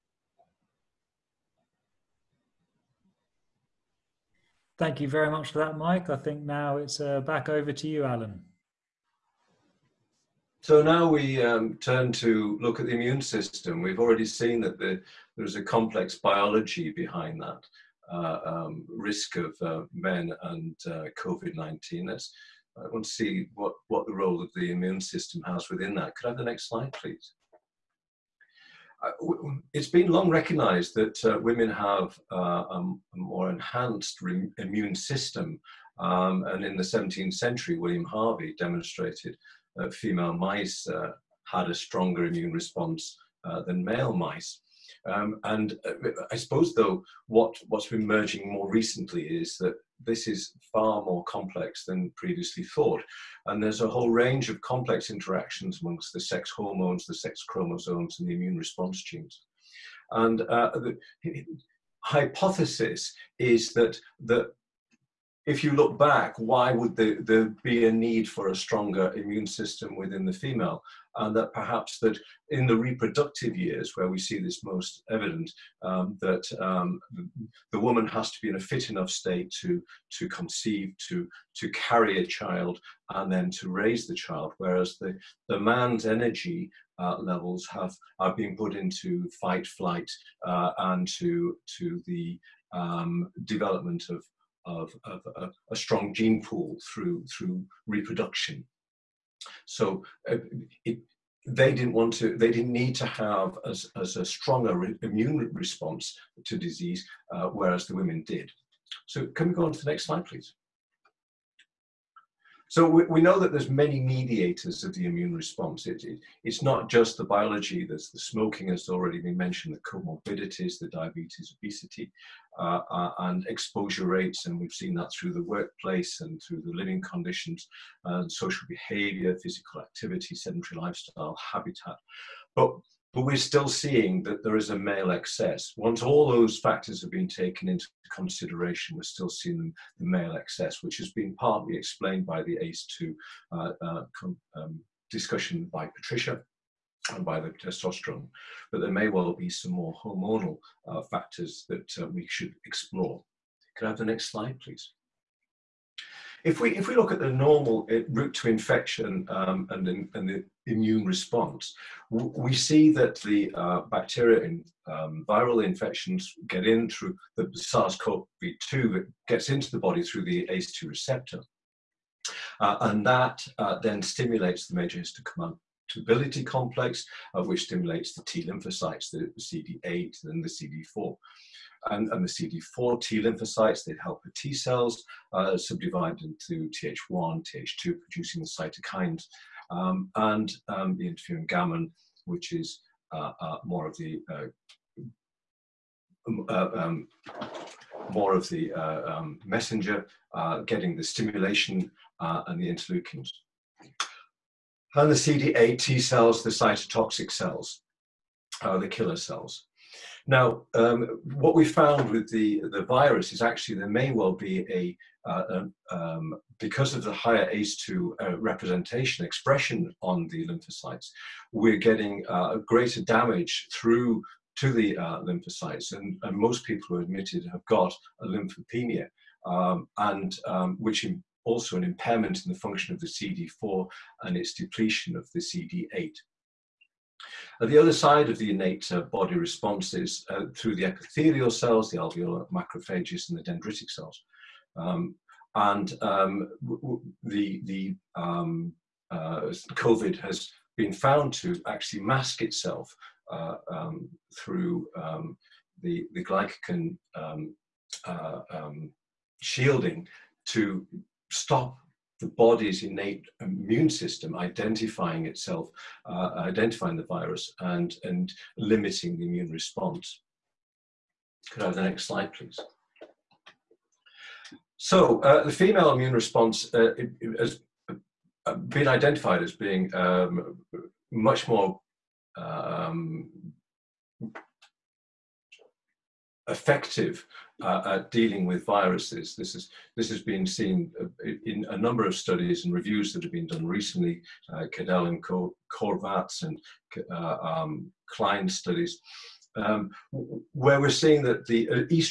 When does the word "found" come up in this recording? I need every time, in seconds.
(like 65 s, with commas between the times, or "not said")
211 s, 250 s.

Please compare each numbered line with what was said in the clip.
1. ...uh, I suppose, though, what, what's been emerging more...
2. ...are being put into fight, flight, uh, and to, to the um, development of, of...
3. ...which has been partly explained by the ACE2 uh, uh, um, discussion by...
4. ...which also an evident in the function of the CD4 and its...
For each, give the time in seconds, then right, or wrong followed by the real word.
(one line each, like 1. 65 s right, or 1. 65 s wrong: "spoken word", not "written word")
1. 45 s right
2. 88 s right
3. 140 s right
4. 230 s wrong: "impairment", not "evident".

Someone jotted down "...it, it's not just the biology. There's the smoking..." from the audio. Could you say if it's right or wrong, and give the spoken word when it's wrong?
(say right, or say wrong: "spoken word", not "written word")
right.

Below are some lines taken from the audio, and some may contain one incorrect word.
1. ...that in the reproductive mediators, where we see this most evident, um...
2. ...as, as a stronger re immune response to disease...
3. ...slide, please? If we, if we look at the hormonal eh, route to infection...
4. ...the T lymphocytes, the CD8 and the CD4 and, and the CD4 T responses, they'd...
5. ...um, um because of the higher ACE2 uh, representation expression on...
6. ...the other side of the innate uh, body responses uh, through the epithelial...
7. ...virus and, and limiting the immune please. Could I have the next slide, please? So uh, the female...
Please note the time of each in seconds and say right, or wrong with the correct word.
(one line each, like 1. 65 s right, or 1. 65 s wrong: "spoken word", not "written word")
1. 71 s wrong: "years", not "mediators"
2. 103 s right
3. 154 s wrong: "normal", not "hormonal"
4. 178 s wrong: "lymphocytes", not "responses"
5. 215 s right
6. 237 s right
7. 267 s wrong: "response", not "please".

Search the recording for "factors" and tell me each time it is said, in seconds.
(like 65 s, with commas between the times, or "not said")
136 s, 151 s.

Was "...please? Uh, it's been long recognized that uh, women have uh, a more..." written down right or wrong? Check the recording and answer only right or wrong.
right.